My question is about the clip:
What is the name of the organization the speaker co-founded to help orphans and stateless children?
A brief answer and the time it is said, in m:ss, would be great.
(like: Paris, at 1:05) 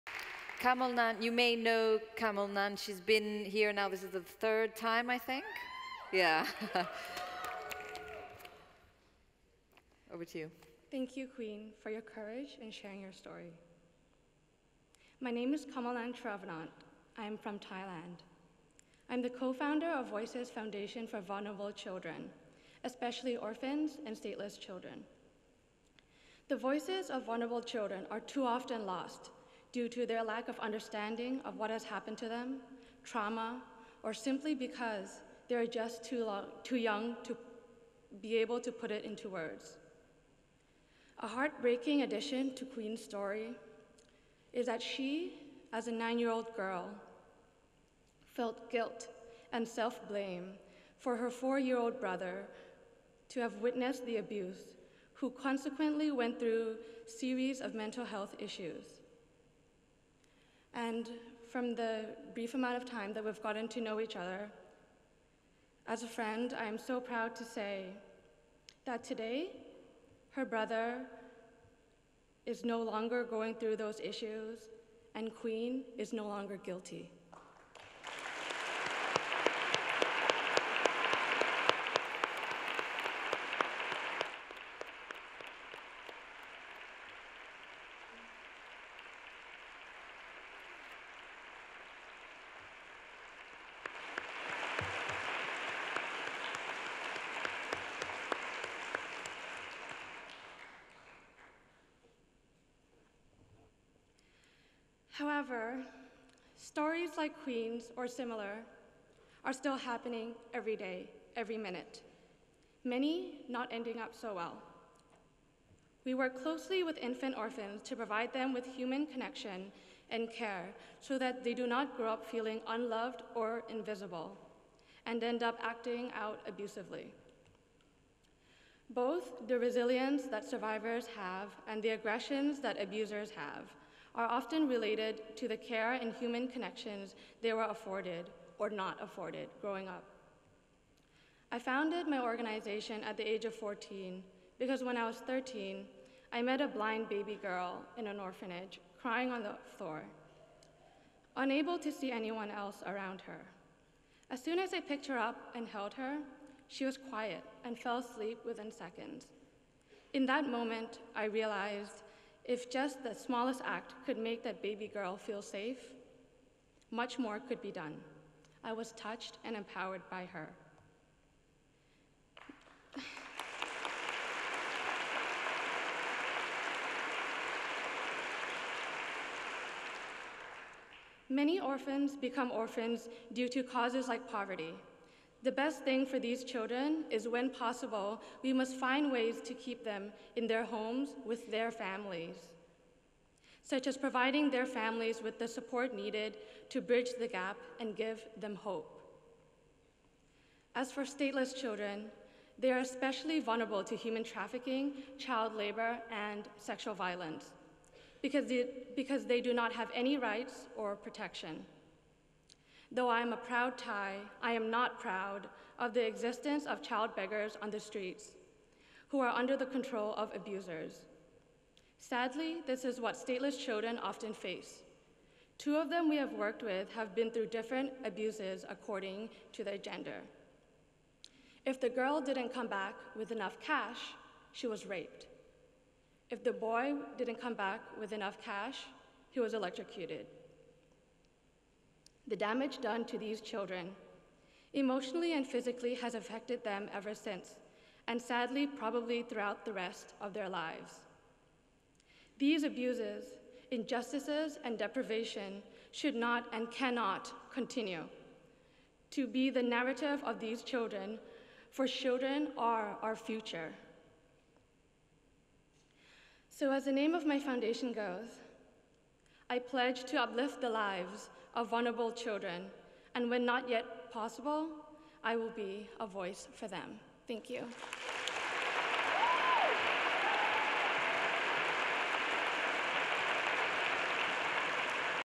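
Voices Foundation for Vulnerable Children, at 0:20.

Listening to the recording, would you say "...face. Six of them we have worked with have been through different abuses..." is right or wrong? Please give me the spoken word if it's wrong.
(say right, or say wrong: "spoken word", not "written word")
wrong: "Two", not "Six".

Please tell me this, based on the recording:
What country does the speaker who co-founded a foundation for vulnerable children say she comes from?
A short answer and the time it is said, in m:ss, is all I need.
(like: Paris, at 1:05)
Thailand, at 0:17.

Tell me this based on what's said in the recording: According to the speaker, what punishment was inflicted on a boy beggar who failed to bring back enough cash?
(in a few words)
He was electrocuted.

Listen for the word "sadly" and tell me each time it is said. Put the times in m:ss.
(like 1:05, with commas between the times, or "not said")
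3:41, 4:08.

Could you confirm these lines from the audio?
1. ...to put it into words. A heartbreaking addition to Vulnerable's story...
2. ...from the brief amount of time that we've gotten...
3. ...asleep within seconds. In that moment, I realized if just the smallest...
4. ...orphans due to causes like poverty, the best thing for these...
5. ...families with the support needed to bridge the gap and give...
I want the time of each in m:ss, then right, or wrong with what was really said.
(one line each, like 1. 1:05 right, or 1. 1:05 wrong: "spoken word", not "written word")
1. 0:38 wrong: "Queen", not "Vulnerable"
2. 1:01 right
3. 2:37 right
4. 3:02 right
5. 3:14 right.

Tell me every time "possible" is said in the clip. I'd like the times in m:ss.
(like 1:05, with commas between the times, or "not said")
3:07, 4:34.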